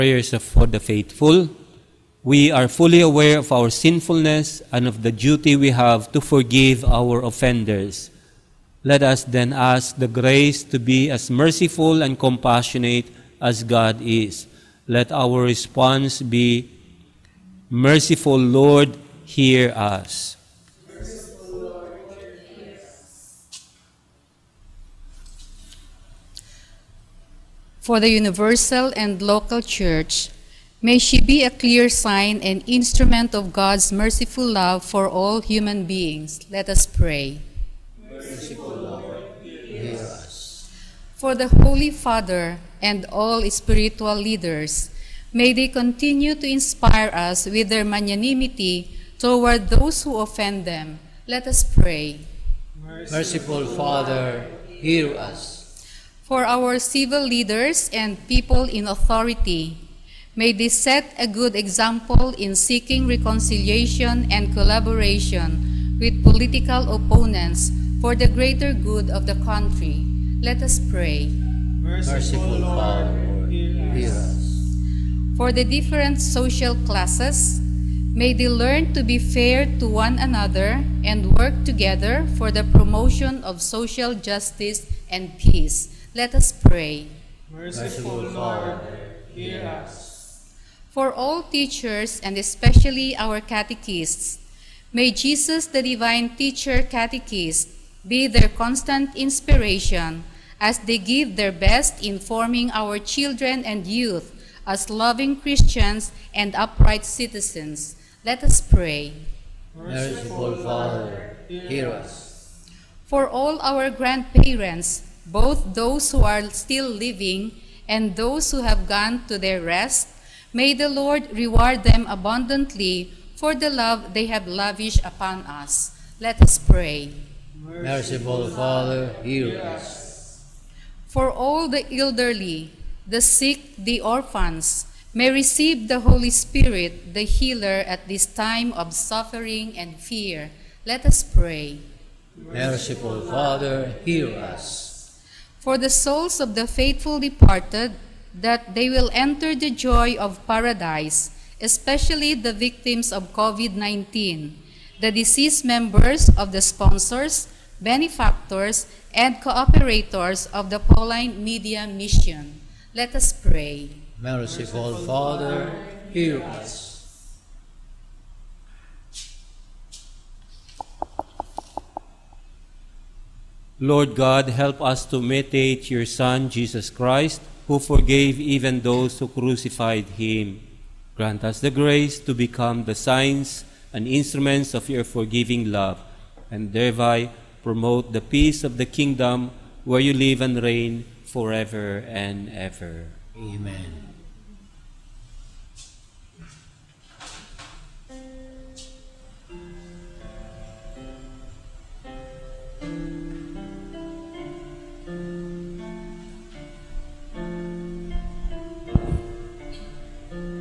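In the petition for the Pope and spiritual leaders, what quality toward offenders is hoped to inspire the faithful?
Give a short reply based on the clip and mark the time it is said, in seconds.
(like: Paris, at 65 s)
Magnanimity, at 47 s.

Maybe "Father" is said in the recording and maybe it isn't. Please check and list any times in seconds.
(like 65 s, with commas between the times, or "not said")
41 s, 53 s, 72 s, 110 s, 128 s, 143 s, 165 s.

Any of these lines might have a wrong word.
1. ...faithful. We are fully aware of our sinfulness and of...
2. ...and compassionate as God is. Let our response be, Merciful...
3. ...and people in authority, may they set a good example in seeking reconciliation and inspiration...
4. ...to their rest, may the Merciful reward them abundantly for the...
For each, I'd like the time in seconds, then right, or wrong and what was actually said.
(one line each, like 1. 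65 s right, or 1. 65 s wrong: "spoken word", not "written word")
1. 0 s right
2. 12 s right
3. 57 s wrong: "collaboration", not "inspiration"
4. 119 s wrong: "Lord", not "Merciful".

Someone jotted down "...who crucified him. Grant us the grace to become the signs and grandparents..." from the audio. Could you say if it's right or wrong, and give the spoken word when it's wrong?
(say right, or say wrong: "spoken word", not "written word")
wrong: "instruments", not "grandparents".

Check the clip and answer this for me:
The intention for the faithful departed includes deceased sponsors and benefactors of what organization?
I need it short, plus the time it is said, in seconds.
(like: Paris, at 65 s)
Pauline Media Mission, at 160 s.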